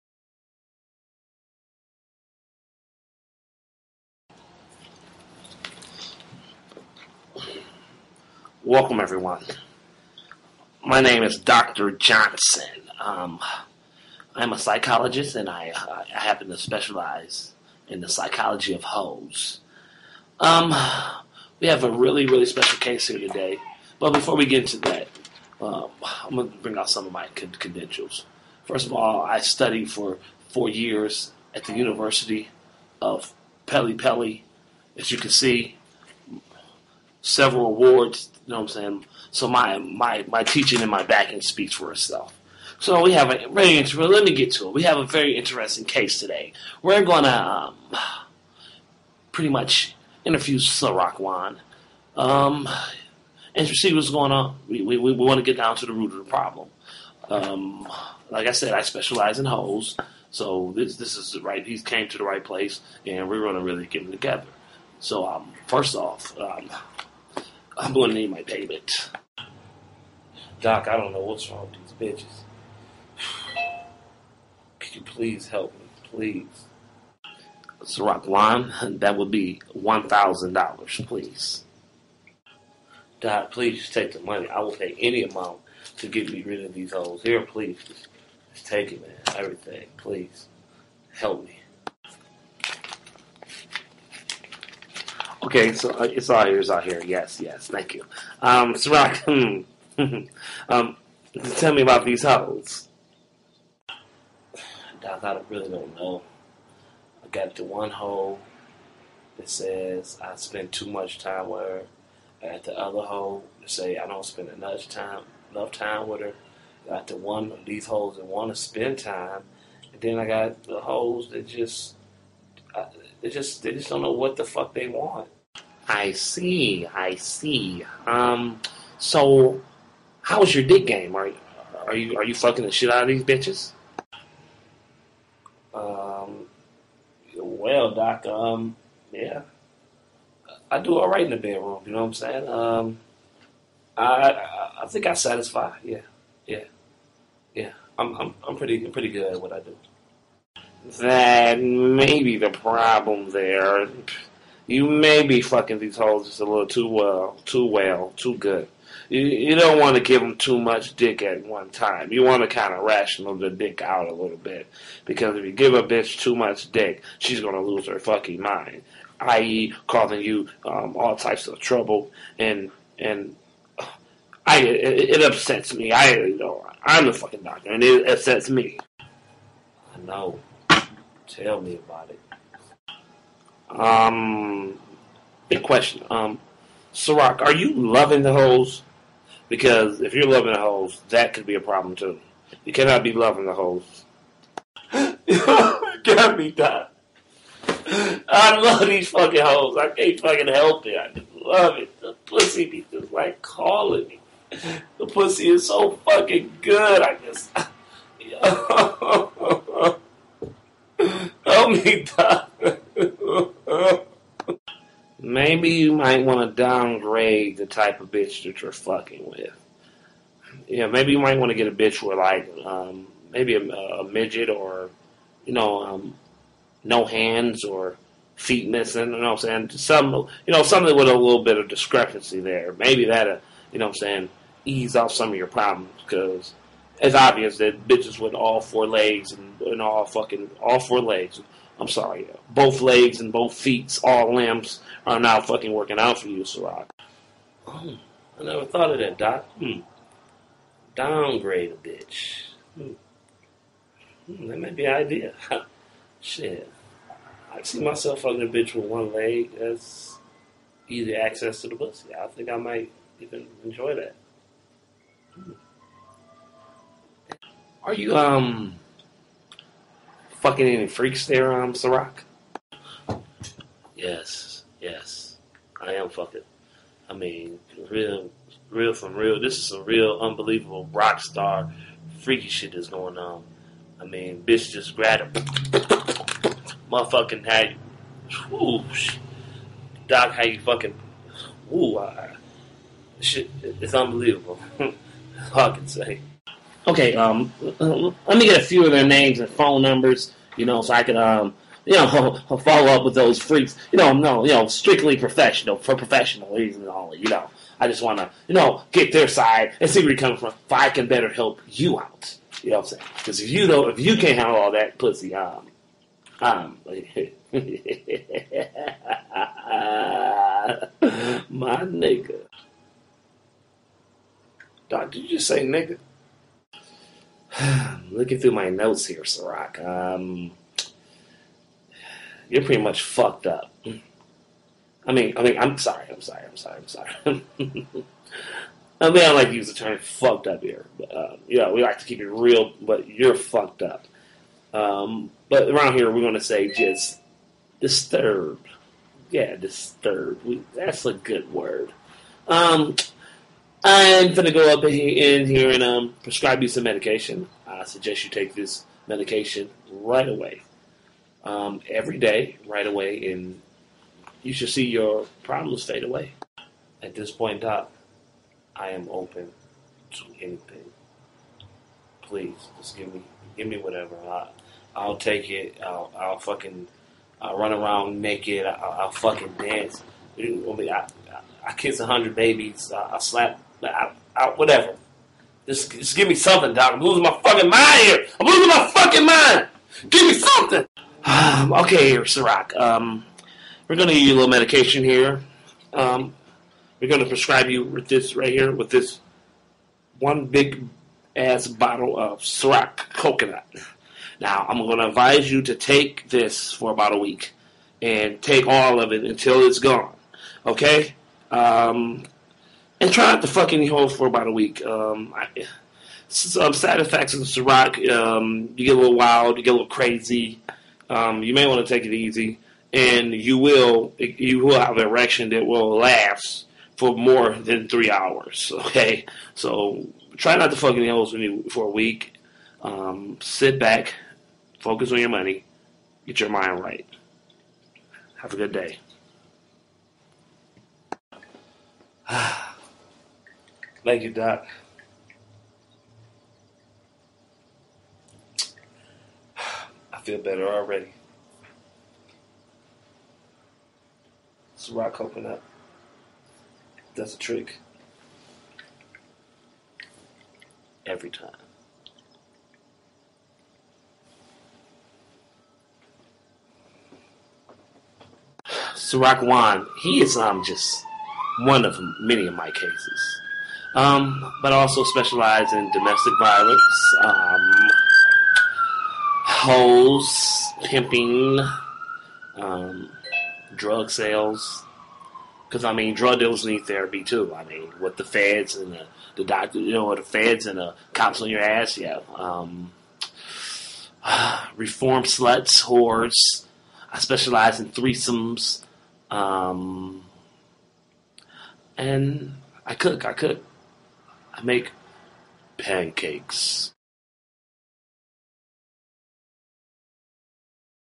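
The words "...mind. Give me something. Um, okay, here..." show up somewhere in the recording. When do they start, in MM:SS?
06:29.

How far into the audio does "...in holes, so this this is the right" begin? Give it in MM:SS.
00:59.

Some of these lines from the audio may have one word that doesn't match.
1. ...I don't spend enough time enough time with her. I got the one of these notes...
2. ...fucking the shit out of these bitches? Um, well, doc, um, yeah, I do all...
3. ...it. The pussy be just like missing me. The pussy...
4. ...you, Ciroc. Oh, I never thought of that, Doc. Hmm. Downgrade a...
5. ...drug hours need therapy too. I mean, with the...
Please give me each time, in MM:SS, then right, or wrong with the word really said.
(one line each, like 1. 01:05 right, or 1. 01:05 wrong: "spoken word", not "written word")
1. 01:53 wrong: "holes", not "notes"
2. 02:12 right
3. 03:21 wrong: "calling", not "missing"
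4. 04:06 right
5. 08:06 wrong: "dealers", not "hours".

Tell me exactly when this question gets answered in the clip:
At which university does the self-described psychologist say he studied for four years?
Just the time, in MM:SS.
00:31.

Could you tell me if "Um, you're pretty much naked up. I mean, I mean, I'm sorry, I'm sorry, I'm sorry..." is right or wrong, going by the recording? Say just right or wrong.
wrong.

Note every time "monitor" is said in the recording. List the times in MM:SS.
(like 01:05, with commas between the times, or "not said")
not said.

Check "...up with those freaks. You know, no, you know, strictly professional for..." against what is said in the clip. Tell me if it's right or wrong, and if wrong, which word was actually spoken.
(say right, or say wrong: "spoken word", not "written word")
right.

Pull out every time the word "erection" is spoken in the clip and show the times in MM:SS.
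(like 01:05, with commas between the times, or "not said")
07:05.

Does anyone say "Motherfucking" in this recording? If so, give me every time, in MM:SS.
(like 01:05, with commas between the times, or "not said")
04:46.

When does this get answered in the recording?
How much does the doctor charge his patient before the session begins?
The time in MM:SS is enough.
01:19.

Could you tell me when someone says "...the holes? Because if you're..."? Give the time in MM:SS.
03:08.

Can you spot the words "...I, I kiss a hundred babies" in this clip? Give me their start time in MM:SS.
06:20.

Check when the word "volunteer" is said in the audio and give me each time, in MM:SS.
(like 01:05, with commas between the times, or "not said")
not said.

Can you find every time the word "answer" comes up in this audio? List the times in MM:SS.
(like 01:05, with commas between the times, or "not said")
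not said.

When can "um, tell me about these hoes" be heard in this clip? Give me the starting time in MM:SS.
01:40.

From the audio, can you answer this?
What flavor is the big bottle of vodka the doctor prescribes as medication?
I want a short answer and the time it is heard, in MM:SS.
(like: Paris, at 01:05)
coconut, at 06:43.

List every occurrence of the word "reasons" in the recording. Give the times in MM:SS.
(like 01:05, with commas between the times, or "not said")
05:06.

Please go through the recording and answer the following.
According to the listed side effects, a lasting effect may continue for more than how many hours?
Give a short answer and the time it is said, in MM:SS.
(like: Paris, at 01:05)
3, at 07:07.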